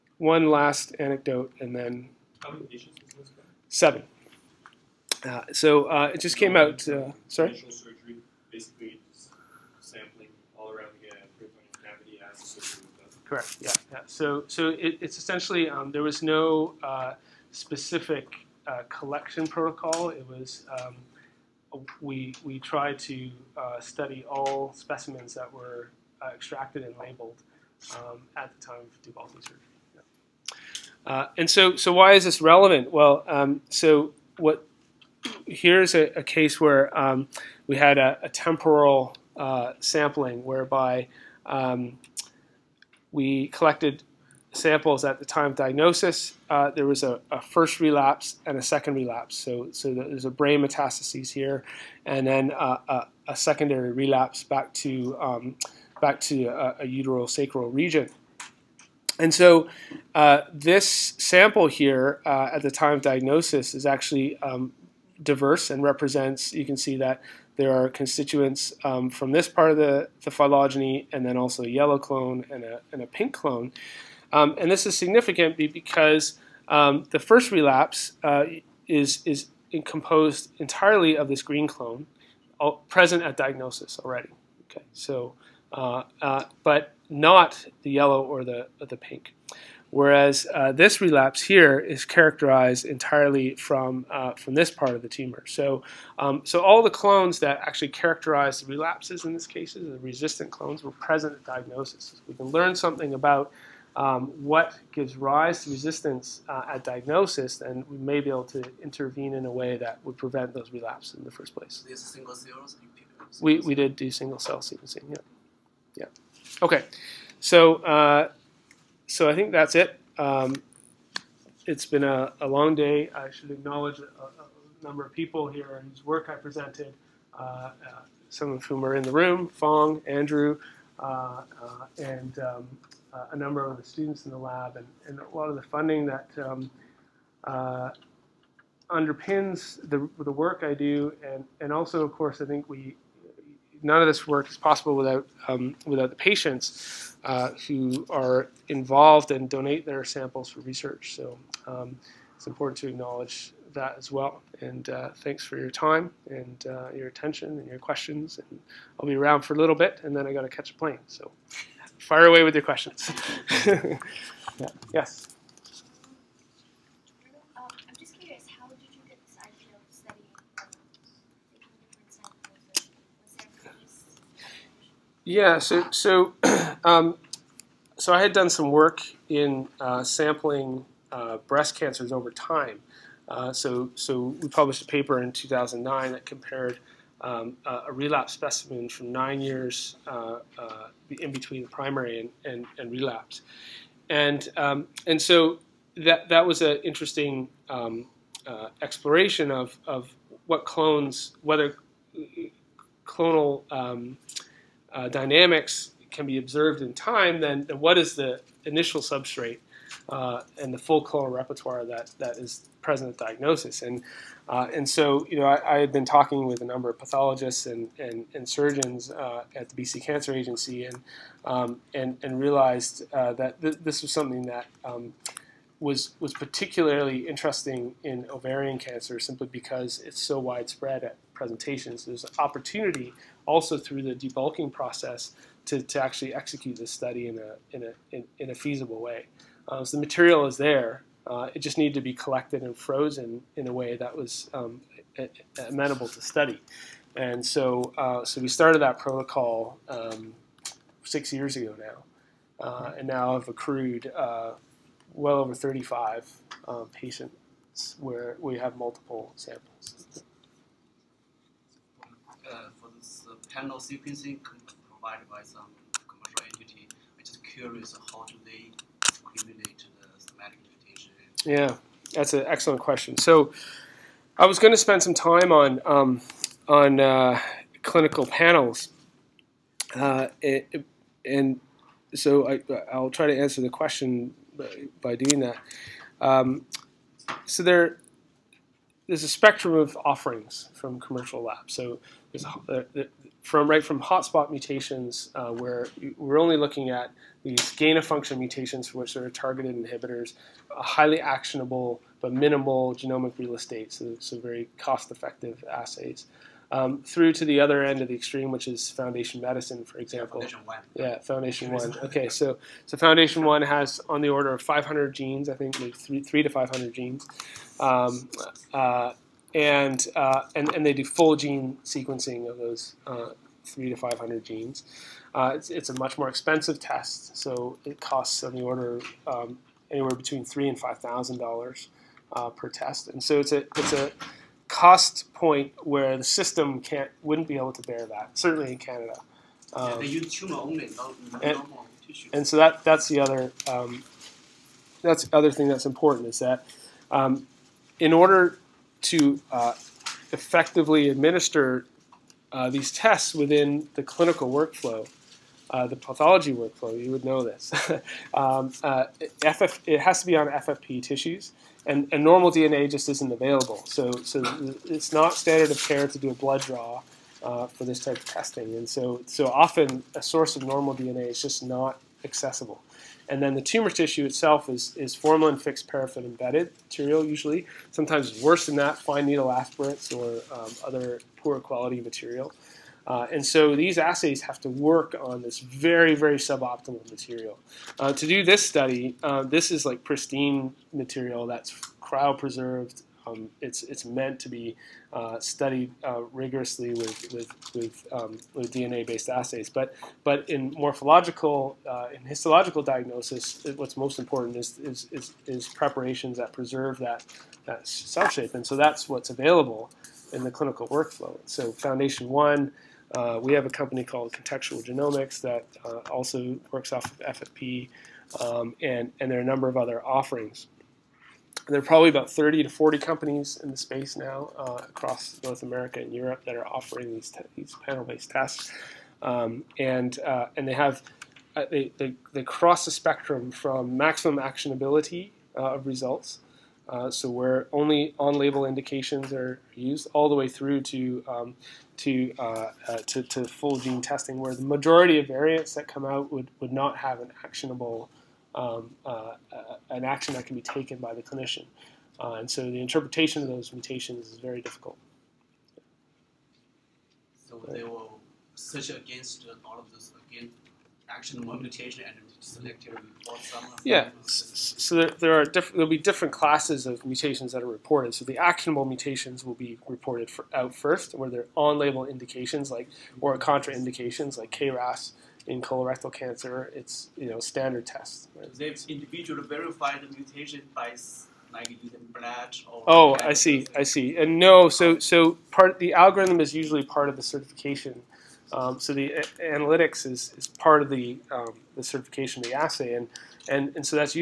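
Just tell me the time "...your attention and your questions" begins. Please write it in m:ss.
2:36.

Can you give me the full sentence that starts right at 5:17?
Um, uh, and, uh, and, and they do full gene sequencing of those uh, three to 500 genes.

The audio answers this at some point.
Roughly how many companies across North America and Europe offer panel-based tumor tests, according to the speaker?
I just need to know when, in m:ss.
7:02.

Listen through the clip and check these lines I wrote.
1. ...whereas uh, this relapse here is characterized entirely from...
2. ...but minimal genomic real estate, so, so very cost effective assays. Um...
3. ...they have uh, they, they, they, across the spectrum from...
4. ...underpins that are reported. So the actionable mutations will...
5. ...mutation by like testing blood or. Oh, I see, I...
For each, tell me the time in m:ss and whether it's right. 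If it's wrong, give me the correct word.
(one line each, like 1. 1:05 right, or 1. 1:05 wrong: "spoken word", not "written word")
1. 1:29 right
2. 5:02 right
3. 7:10 wrong: "cross", not "across"
4. 7:47 wrong: "mutations", not "underpins"
5. 8:00 wrong: "using", not "testing".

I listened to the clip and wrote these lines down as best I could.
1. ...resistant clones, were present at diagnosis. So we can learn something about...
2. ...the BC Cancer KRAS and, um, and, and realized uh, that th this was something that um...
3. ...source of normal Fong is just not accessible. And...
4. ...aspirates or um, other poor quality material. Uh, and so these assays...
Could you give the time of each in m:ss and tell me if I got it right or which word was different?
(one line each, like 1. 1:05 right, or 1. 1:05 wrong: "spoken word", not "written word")
1. 1:40 right
2. 3:39 wrong: "Agency", not "KRAS"
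3. 6:10 wrong: "DNA", not "Fong"
4. 6:19 right.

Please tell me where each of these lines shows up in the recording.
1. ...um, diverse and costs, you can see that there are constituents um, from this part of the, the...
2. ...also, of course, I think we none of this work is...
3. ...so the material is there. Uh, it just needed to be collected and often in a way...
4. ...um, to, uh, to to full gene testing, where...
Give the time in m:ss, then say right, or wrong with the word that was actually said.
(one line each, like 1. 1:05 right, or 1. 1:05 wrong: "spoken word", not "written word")
1. 1:04 wrong: "represents", not "costs"
2. 2:21 right
3. 3:59 wrong: "frozen", not "often"
4. 7:21 right.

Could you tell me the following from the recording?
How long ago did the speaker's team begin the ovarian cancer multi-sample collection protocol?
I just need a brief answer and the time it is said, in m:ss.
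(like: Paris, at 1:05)
6 years, at 4:11.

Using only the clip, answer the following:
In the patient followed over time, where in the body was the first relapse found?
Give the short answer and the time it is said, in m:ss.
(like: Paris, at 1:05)
brain, at 0:50.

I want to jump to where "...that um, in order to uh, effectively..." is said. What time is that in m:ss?
5:46.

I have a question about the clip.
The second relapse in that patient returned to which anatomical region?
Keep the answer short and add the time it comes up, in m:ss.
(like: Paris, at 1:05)
sacral region, at 0:57.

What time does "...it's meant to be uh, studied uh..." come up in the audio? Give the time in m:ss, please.
6:33.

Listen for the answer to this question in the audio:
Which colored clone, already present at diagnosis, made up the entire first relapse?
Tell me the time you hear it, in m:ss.
1:21.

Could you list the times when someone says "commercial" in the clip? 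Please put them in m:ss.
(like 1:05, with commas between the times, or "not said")
4:26, 4:50.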